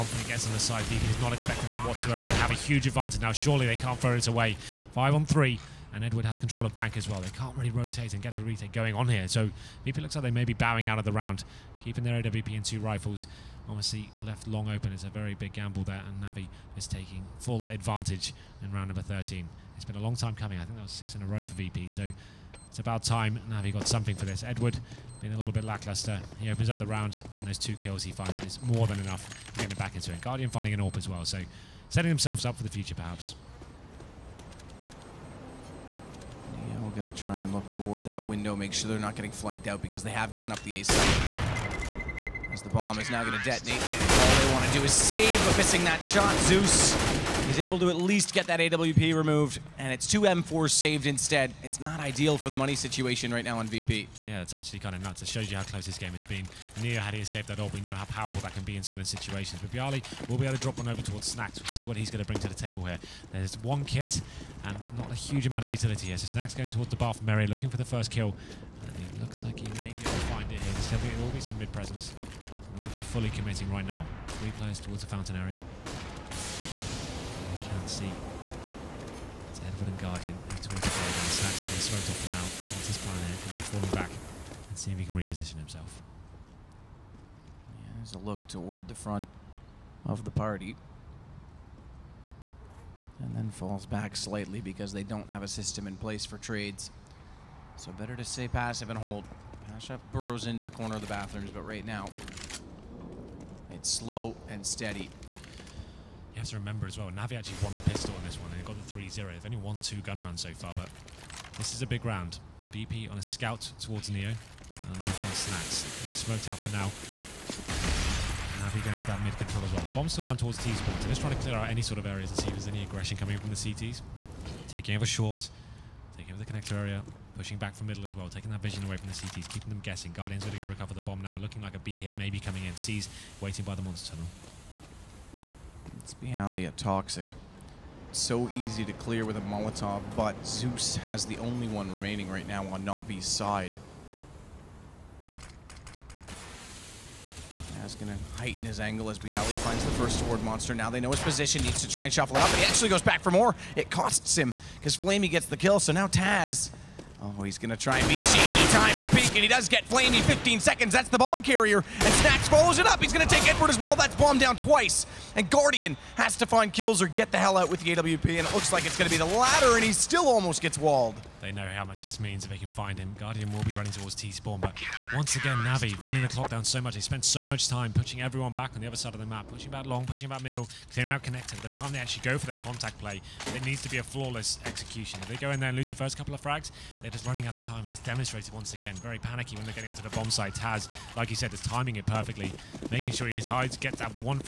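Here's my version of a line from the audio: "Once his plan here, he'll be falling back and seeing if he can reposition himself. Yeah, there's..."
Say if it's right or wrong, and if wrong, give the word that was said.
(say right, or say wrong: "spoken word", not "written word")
right.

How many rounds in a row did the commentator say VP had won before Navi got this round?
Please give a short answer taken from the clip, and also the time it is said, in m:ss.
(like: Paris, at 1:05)
6, at 0:20.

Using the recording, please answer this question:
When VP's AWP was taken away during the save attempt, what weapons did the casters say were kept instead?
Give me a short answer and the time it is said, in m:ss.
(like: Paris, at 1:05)
Two M4s, at 0:50.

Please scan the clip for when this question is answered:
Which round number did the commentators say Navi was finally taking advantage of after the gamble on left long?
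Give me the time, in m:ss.
0:18.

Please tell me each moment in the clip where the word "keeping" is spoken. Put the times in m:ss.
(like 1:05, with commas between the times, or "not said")
0:11, 2:09.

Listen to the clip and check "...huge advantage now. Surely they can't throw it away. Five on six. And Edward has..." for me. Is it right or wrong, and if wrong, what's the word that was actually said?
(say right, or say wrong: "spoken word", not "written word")
wrong: "three", not "six".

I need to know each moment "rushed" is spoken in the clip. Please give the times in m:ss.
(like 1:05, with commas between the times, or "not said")
not said.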